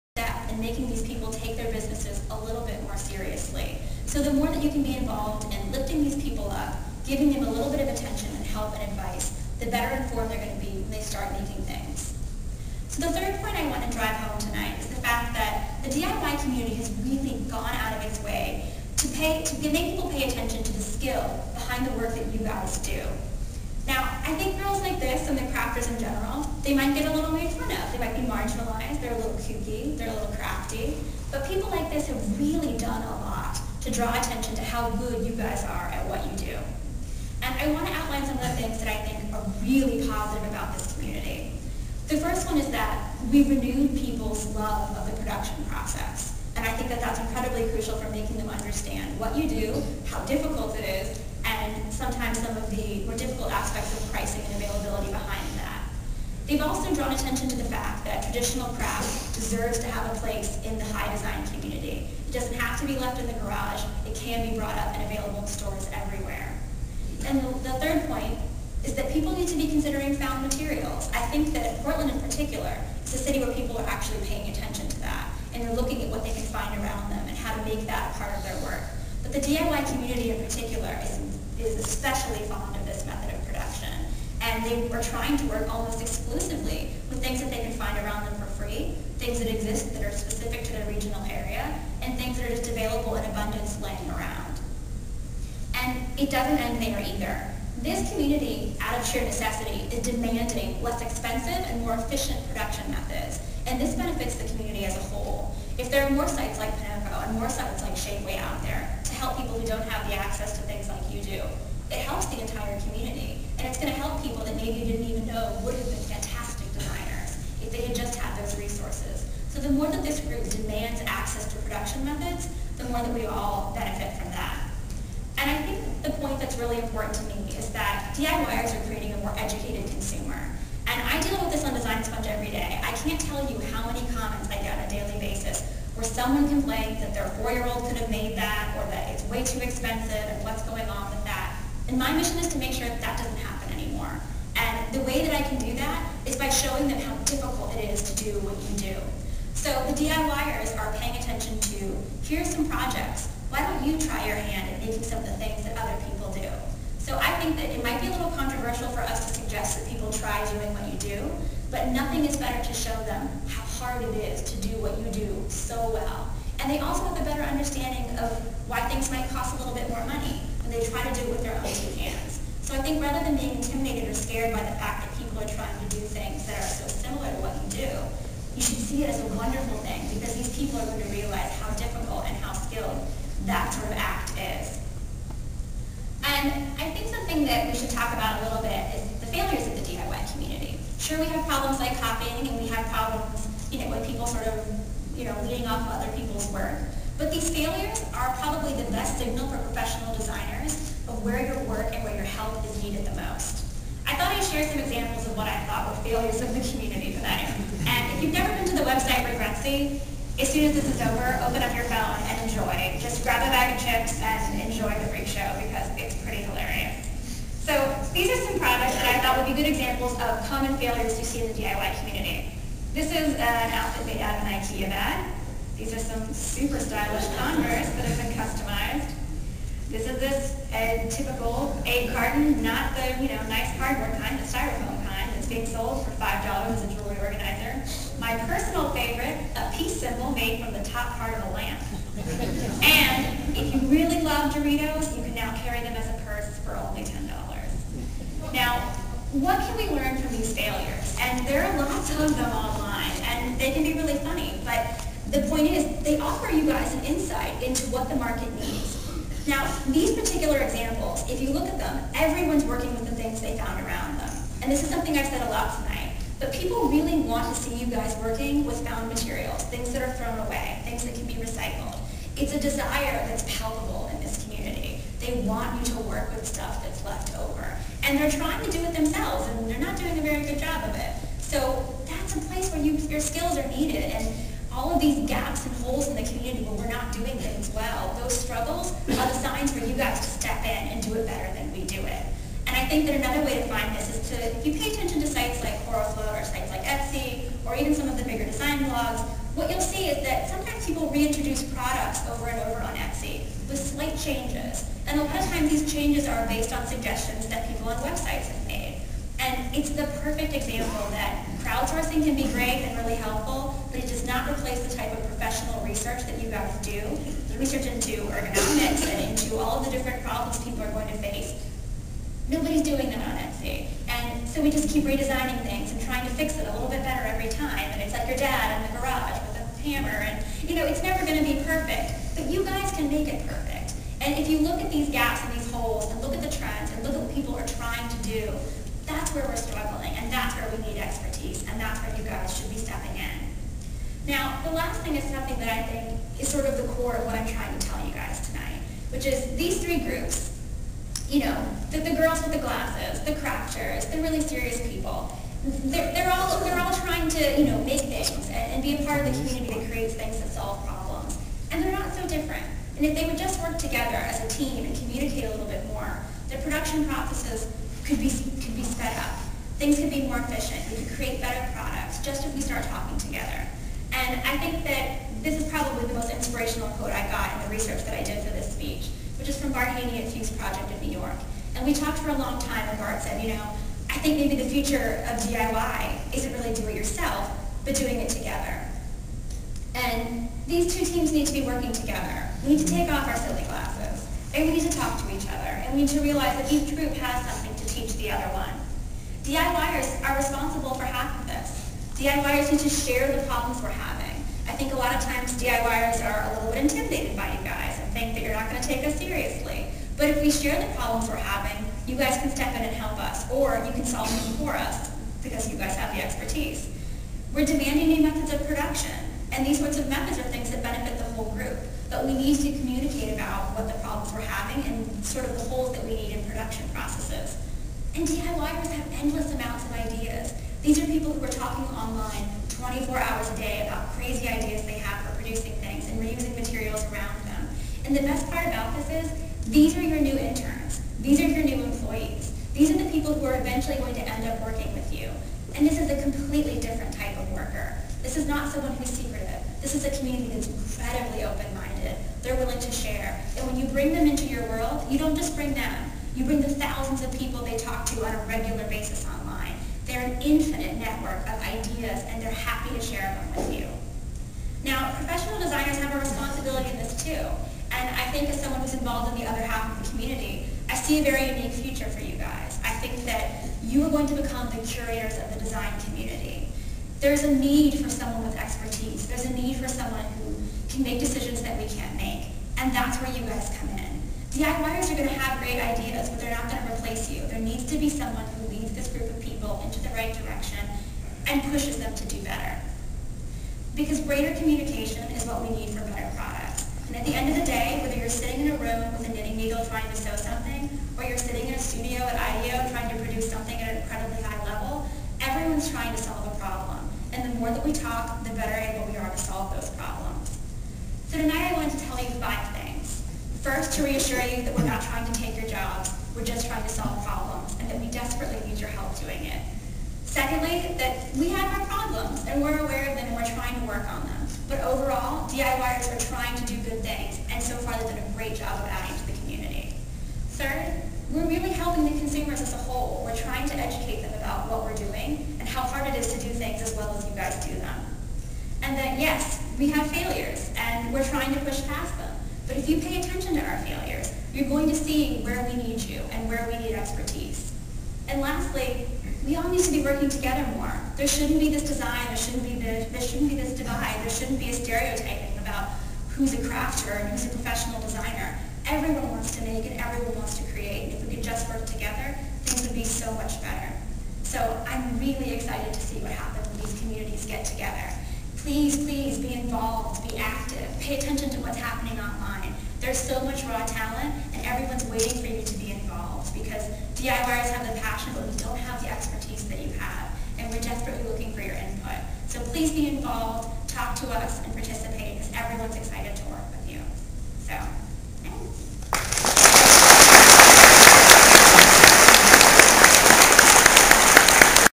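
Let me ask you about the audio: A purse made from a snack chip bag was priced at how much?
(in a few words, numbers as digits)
$10.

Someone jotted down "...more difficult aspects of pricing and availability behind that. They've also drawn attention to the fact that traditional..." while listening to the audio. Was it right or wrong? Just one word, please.
right.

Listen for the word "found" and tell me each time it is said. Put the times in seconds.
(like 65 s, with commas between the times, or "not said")
70 s, 263 s, 268 s.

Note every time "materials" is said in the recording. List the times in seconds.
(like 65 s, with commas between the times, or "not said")
70 s, 269 s, 436 s.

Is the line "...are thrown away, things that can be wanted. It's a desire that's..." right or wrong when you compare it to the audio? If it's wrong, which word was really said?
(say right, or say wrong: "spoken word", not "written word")
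wrong: "recycled", not "wanted".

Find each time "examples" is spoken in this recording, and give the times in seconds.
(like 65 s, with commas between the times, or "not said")
204 s, 219 s, 260 s, 310 s.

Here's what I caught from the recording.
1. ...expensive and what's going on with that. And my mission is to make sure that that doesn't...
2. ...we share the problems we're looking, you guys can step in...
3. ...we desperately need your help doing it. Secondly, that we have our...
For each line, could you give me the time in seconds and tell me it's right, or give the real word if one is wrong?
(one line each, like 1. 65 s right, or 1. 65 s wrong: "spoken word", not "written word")
1. 139 s right
2. 410 s wrong: "having", not "looking"
3. 518 s right.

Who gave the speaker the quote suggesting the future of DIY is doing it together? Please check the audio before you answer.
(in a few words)
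Bart Haney.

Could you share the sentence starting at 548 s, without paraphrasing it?
And lastly, we all need to be working together more.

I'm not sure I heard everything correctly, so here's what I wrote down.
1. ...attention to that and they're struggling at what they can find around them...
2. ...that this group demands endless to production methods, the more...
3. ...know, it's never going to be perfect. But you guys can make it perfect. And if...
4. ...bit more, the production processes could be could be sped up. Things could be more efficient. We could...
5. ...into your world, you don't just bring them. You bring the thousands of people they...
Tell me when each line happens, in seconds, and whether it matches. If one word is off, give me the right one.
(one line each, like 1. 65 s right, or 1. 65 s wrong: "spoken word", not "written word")
1. 74 s wrong: "looking", not "struggling"
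2. 119 s wrong: "access", not "endless"
3. 330 s right
4. 365 s right
5. 454 s right.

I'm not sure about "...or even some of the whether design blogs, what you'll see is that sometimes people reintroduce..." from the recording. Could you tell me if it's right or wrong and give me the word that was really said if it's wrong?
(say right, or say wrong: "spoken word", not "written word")
wrong: "bigger", not "whether".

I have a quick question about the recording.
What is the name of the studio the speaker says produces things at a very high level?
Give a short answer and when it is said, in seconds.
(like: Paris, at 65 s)
IDEO, at 502 s.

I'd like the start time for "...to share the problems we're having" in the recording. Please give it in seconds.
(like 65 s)
402 s.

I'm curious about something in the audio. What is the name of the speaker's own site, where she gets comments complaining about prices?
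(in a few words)
Design Sponge.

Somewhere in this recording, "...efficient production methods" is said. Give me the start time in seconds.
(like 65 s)
101 s.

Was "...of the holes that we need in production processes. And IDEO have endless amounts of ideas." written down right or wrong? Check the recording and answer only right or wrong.
wrong.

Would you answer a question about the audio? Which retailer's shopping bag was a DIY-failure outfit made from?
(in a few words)
IKEA.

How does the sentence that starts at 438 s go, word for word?
And the best part about this is these are your new interns.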